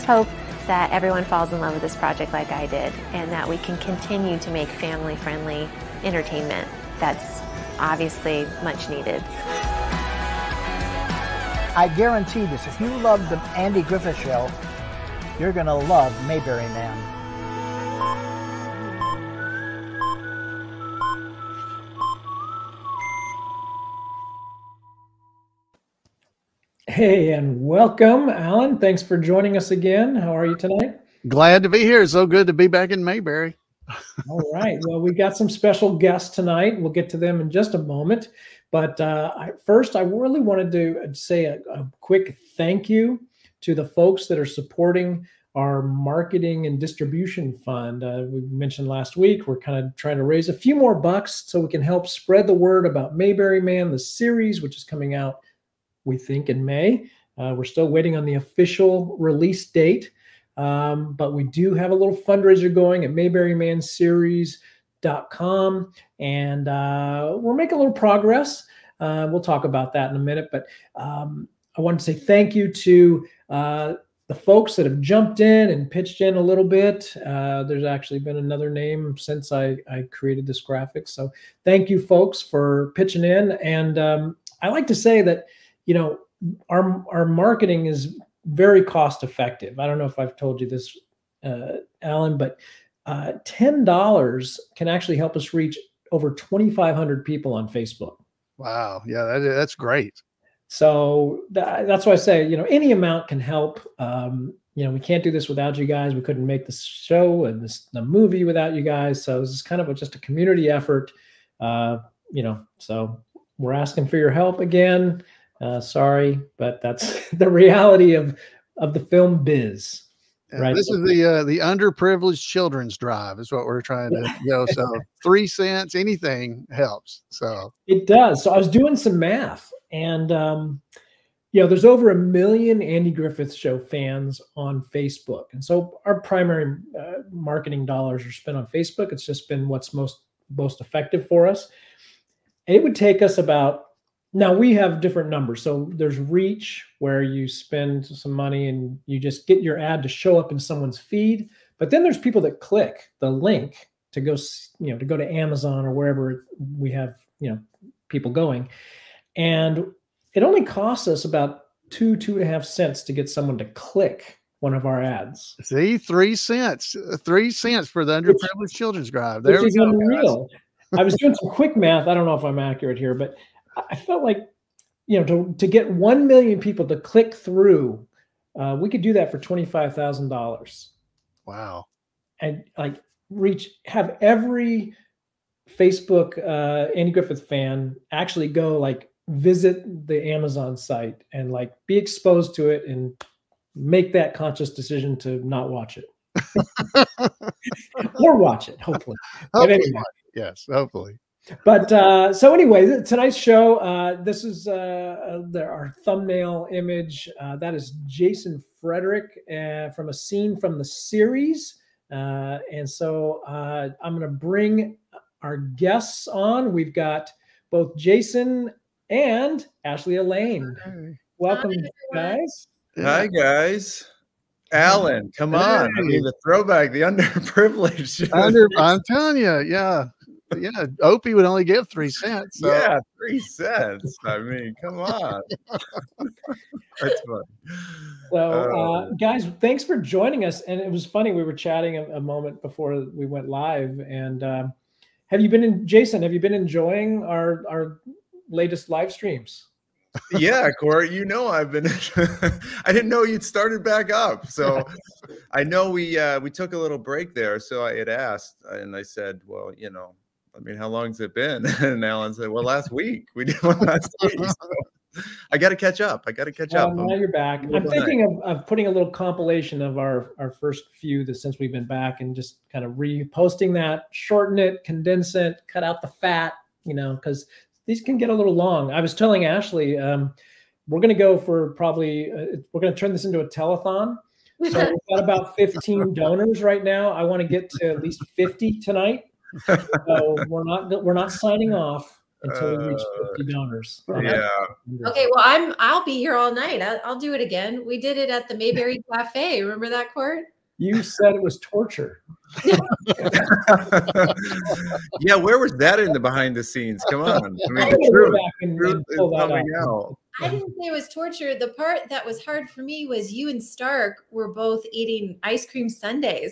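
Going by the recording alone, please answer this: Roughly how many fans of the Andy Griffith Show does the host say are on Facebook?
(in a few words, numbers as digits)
over 1 million.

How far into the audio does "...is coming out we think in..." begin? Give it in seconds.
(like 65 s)
54 s.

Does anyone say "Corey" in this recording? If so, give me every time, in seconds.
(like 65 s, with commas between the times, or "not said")
250 s.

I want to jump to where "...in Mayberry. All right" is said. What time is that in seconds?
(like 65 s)
32 s.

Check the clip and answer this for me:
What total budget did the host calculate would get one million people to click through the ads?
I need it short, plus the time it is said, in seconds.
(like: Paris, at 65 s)
$25,000, at 179 s.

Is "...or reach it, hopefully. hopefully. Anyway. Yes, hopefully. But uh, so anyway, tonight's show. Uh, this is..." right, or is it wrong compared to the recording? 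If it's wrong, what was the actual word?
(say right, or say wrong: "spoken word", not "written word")
wrong: "watch", not "reach".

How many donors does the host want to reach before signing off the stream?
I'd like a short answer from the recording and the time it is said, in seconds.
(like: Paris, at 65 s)
50, at 293 s.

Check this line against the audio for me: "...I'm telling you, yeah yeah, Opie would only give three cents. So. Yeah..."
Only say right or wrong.
right.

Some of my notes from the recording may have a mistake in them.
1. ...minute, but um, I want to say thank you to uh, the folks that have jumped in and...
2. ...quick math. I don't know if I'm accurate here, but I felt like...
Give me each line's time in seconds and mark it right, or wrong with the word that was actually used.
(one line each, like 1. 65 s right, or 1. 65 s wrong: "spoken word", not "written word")
1. 70 s right
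2. 171 s right.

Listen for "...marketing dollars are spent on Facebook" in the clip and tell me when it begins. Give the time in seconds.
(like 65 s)
137 s.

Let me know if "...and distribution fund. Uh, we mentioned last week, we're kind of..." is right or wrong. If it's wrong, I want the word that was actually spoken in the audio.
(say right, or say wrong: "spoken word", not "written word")
right.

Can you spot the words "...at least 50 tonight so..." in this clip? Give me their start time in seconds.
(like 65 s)
287 s.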